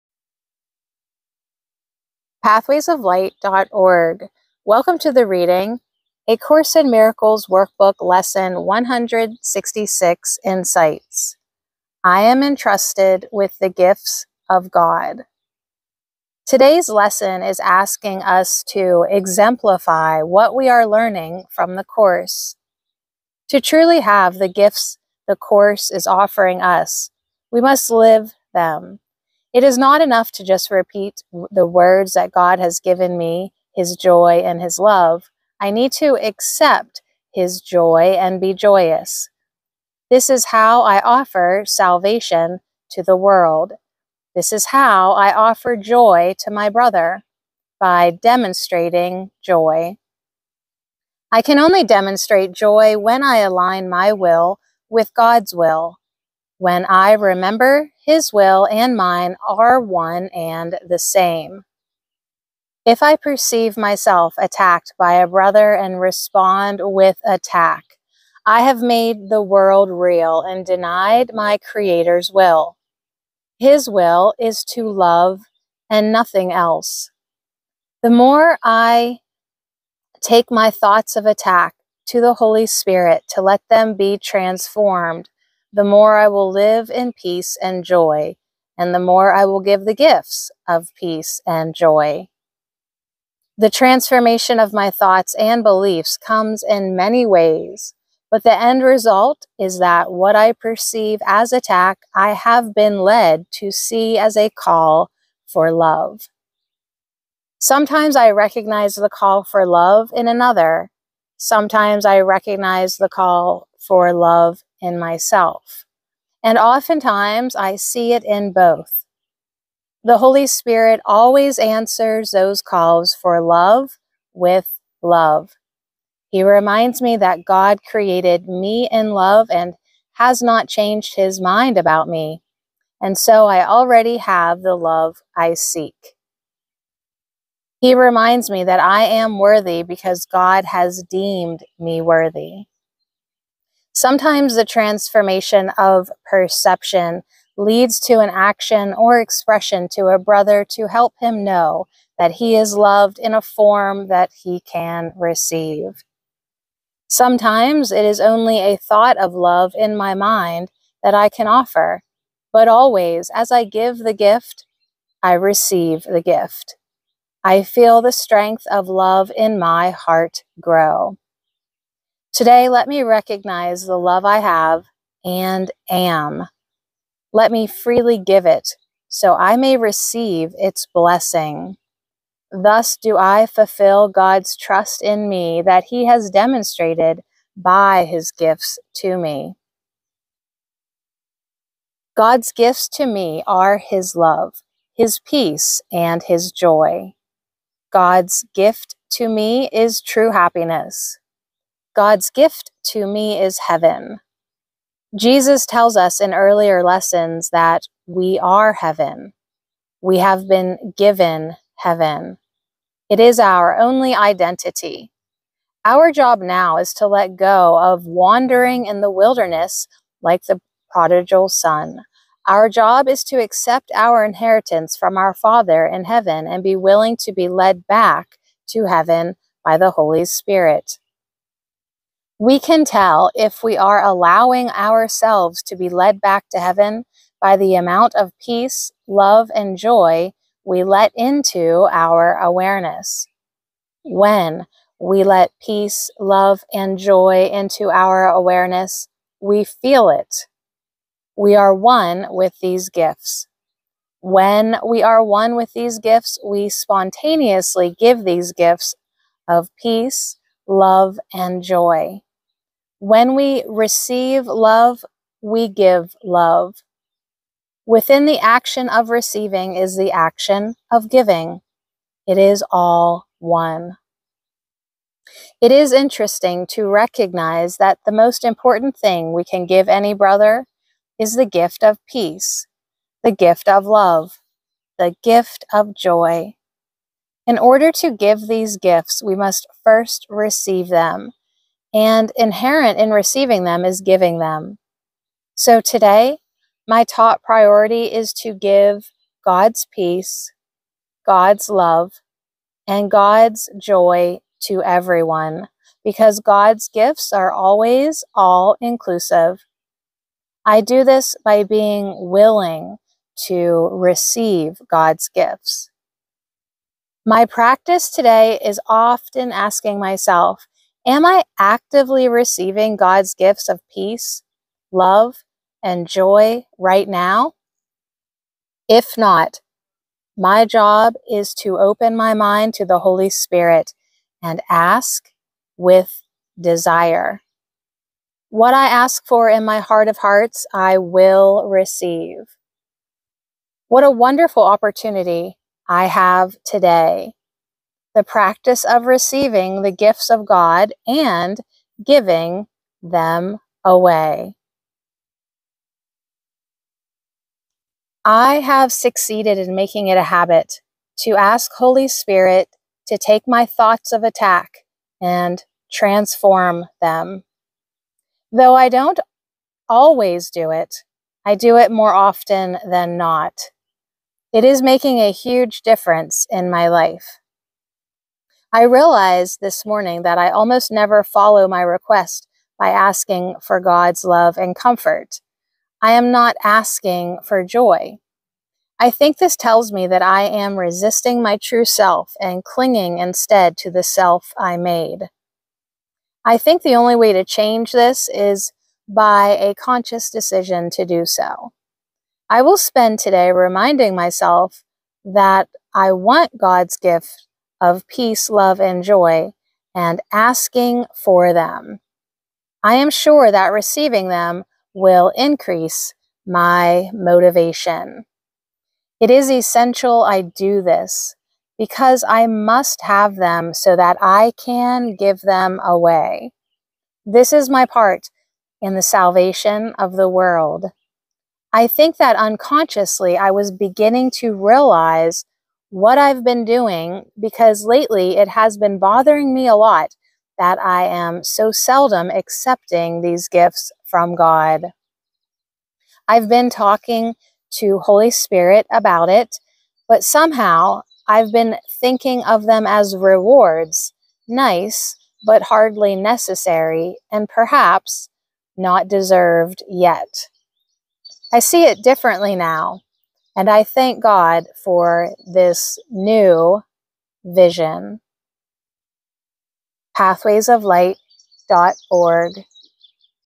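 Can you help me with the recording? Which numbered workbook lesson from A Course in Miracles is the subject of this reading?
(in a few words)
166.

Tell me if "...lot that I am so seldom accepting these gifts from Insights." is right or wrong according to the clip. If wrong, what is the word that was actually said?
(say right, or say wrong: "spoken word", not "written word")
wrong: "God", not "Insights".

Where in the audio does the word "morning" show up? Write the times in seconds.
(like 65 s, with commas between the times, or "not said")
379 s.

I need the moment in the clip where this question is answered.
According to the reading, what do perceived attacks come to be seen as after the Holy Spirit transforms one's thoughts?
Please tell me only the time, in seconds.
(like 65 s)
104 s.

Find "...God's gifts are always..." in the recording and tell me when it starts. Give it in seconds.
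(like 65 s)
306 s.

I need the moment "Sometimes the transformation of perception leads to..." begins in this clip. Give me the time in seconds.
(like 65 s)
143 s.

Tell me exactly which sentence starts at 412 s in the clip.
I am sure that receiving them will increase my motivation.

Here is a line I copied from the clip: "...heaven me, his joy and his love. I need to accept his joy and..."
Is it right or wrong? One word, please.
wrong.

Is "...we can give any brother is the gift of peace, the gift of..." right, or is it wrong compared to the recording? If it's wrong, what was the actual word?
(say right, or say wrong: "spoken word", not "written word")
right.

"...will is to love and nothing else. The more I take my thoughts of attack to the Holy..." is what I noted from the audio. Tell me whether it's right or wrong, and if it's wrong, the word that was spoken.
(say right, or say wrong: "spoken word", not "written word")
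right.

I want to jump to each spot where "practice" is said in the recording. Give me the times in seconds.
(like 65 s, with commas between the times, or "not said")
317 s, 348 s.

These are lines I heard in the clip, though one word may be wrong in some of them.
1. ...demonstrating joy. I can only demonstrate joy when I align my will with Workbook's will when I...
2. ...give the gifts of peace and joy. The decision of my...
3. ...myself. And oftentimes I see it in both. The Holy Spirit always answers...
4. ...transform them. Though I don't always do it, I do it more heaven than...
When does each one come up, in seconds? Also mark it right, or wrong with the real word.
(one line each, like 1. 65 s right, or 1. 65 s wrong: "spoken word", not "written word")
1. 48 s wrong: "God", not "Workbook"
2. 89 s wrong: "transformation", not "decision"
3. 114 s right
4. 365 s wrong: "often", not "heaven".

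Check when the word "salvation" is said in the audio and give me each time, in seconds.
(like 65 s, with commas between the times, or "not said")
41 s, 429 s.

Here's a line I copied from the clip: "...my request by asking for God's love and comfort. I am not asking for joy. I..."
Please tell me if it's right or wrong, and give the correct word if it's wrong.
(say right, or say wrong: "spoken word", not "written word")
right.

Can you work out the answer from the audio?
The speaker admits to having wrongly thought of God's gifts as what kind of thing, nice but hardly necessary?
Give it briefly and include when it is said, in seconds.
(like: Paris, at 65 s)
Rewards, at 453 s.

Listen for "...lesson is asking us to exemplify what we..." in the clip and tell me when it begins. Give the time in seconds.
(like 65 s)
16 s.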